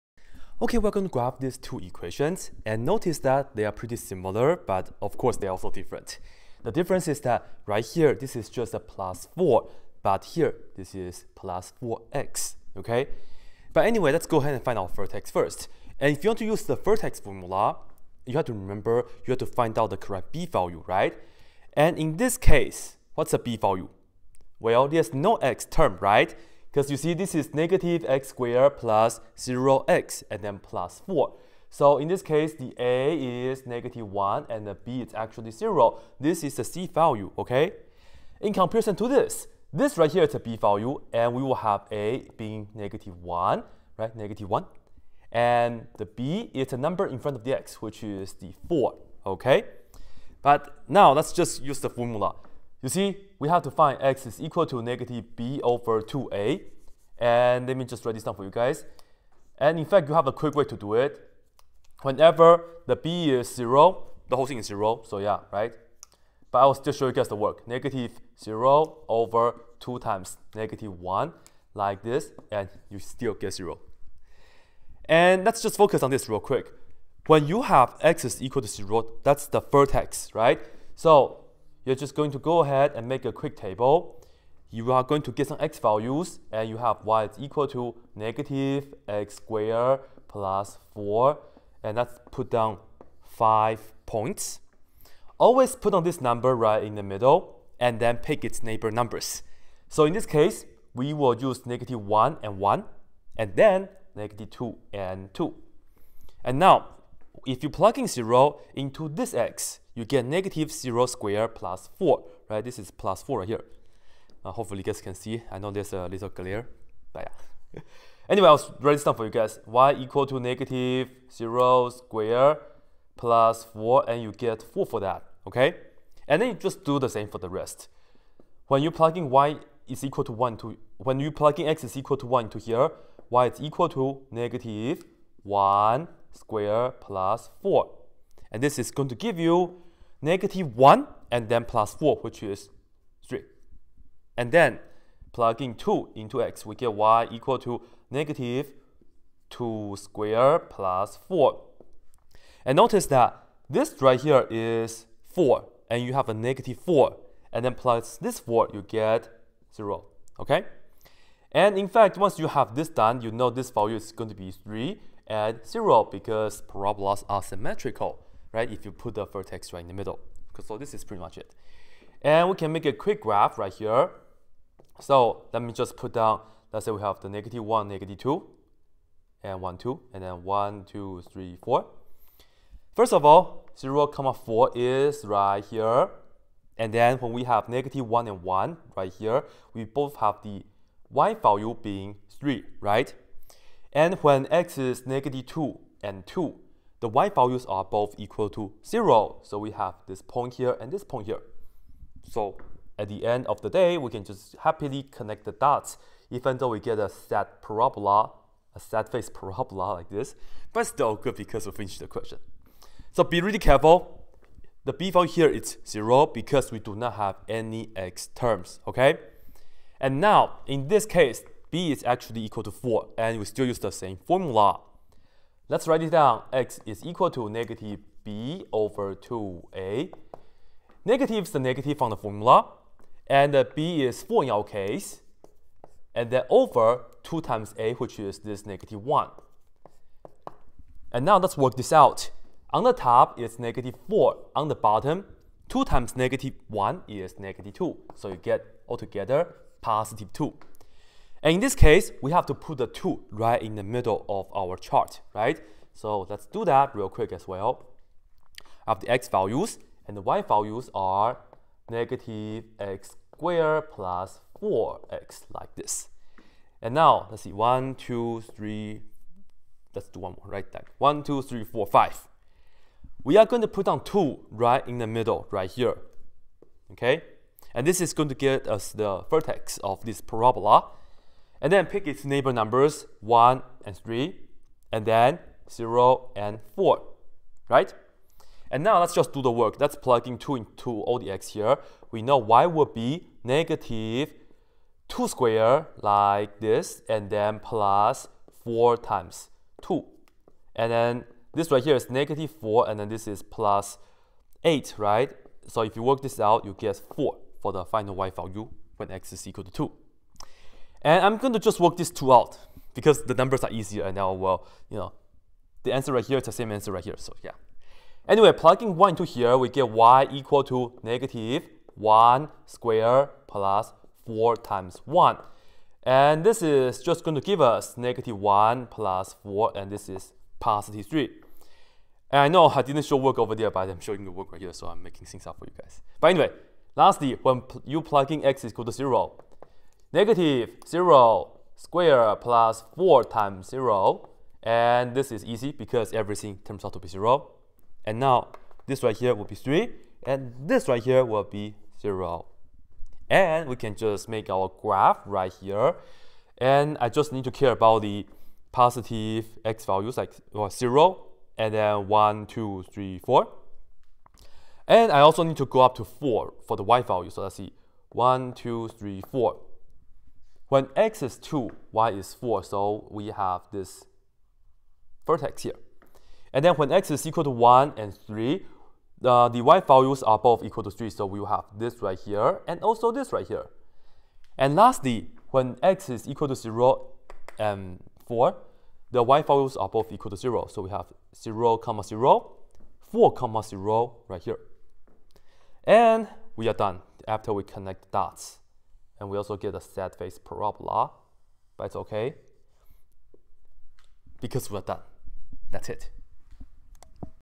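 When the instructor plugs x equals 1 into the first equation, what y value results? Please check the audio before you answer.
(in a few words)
3.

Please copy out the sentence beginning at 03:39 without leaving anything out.
And now, in this case, b is actually equal to 4, and we still use the same formula.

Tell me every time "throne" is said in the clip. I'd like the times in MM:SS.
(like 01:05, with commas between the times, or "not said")
not said.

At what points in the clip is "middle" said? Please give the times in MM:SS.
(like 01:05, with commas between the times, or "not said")
01:37, 02:49, 04:13, 04:35.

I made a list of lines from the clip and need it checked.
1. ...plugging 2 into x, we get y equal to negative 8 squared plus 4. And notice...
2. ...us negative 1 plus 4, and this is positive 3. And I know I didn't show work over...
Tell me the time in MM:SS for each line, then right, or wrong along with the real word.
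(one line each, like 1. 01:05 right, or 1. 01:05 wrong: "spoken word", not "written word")
1. 02:25 wrong: "2", not "8"
2. 05:27 right.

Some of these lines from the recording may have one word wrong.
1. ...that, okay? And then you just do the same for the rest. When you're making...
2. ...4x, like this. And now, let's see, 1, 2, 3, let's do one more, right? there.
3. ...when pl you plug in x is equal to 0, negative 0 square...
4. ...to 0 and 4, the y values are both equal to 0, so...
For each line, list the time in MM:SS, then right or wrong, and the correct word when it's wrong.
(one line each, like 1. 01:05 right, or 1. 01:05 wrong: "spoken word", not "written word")
1. 02:04 wrong: "plugging", not "making"
2. 04:24 right
3. 05:37 right
4. 06:26 right.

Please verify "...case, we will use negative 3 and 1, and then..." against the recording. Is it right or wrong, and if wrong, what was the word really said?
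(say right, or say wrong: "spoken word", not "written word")
wrong: "1", not "3".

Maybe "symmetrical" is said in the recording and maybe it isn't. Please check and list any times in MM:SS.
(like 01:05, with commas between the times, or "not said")
02:47.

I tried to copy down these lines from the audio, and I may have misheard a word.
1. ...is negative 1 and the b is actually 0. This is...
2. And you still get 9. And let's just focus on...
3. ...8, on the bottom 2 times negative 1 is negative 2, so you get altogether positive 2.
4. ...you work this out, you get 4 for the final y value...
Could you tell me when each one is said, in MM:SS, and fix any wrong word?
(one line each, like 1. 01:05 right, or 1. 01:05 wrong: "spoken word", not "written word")
1. 00:33 right
2. 01:12 wrong: "0", not "9"
3. 04:04 wrong: "4", not "8"
4. 05:05 right.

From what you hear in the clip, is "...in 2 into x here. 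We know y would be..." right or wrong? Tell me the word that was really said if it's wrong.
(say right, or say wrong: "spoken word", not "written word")
right.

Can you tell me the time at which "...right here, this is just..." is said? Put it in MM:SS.
00:07.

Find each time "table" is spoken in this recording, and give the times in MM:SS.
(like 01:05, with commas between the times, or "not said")
01:23.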